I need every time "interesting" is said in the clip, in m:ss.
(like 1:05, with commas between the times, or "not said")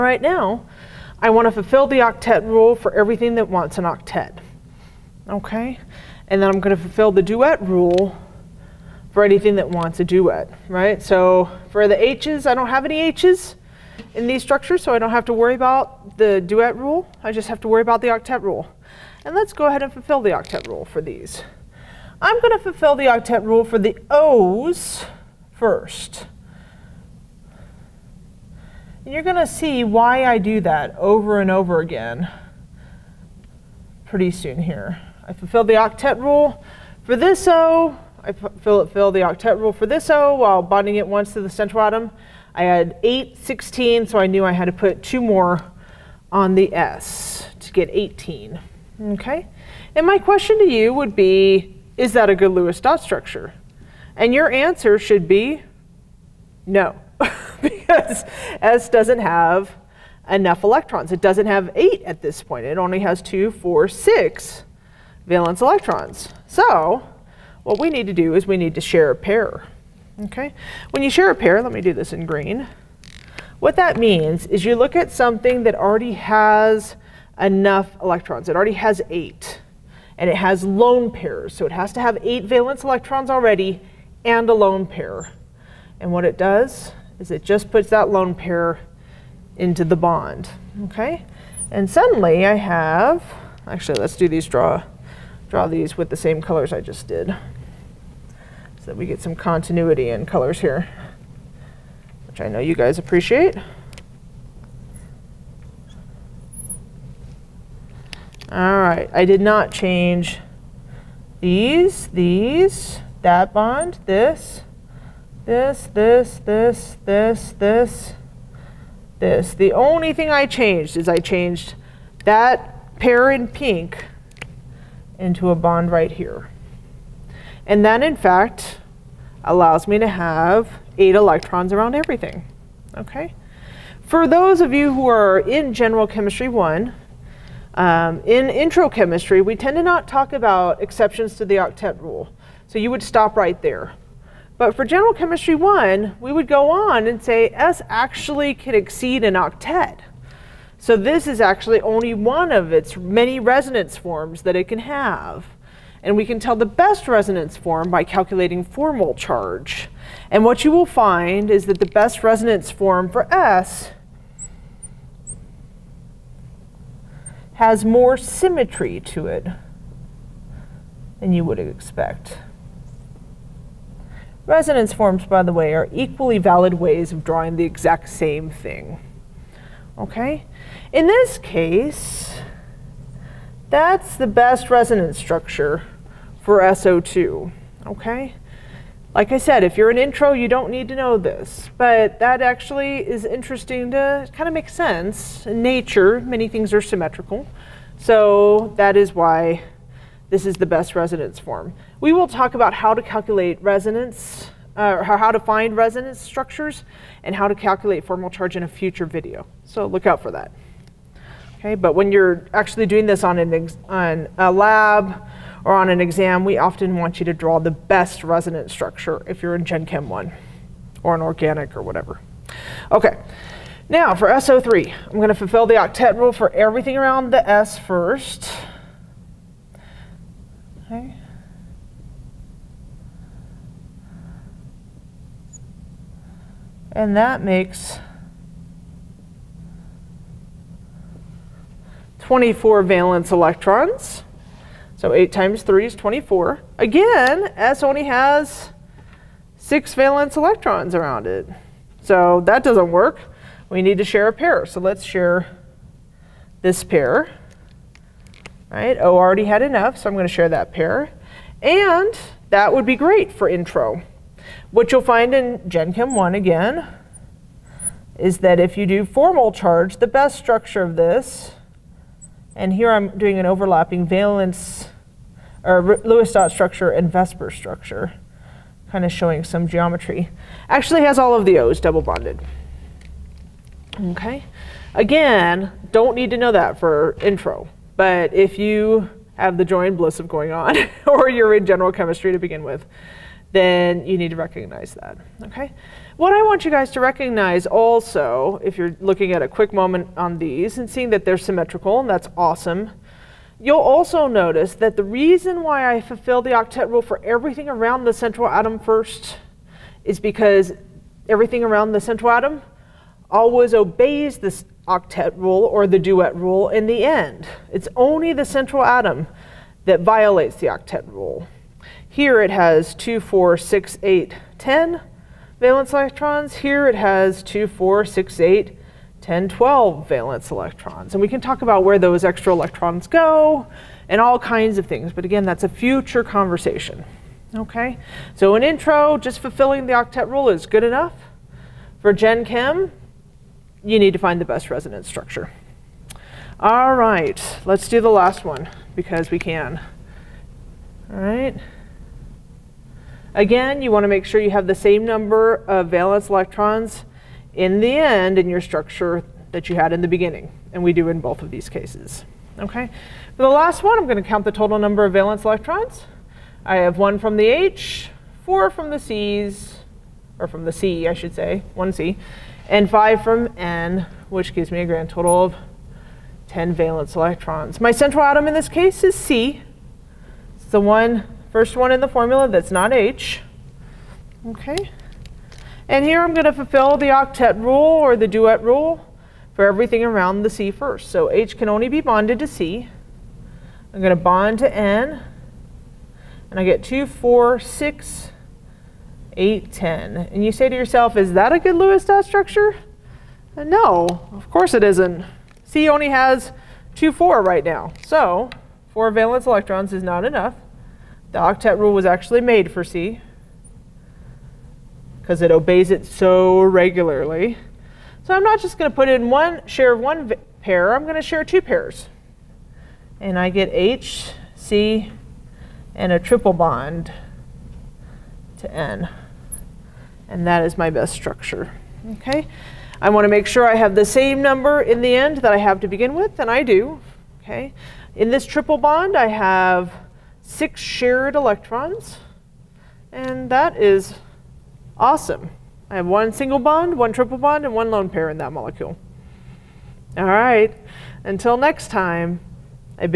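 3:13.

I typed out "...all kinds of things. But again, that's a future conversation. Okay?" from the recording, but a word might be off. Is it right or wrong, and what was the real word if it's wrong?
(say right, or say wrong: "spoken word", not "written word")
right.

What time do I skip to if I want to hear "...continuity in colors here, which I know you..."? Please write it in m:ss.
1:39.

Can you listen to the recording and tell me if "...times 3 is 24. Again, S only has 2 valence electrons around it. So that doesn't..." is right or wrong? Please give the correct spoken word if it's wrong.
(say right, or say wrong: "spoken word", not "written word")
wrong: "6", not "2".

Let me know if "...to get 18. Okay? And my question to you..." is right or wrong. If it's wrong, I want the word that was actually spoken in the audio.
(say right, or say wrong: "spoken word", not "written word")
right.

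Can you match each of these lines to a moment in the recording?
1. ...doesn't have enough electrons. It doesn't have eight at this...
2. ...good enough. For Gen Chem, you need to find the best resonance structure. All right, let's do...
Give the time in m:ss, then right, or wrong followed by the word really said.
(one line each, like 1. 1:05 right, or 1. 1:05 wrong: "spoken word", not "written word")
1. 0:58 right
2. 5:40 right.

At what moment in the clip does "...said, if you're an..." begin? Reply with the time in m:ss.
3:09.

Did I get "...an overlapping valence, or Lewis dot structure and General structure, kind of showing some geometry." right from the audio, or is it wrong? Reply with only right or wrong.
wrong.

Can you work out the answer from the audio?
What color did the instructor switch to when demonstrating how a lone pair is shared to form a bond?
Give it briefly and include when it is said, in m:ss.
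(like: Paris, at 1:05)
Green, at 1:12.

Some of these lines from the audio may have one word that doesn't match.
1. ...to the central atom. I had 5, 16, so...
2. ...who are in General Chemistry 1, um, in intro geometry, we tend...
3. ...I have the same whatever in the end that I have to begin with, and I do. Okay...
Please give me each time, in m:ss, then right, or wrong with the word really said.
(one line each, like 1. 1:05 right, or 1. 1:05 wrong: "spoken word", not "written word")
1. 0:41 wrong: "8", not "5"
2. 2:14 wrong: "chemistry", not "geometry"
3. 7:13 wrong: "number", not "whatever".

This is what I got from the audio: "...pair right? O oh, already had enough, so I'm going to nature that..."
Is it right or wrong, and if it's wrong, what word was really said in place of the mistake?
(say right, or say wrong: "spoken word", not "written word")
wrong: "share", not "nature".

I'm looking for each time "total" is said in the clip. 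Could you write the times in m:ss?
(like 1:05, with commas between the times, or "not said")
6:04, 6:15.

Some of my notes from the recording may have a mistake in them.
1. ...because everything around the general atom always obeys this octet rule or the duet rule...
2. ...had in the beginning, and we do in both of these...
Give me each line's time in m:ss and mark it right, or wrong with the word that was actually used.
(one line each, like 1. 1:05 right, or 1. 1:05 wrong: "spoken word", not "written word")
1. 5:10 wrong: "central", not "general"
2. 5:59 right.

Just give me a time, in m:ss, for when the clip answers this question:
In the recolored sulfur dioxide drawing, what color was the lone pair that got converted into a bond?
2:03.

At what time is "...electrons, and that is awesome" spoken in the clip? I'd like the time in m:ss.
7:21.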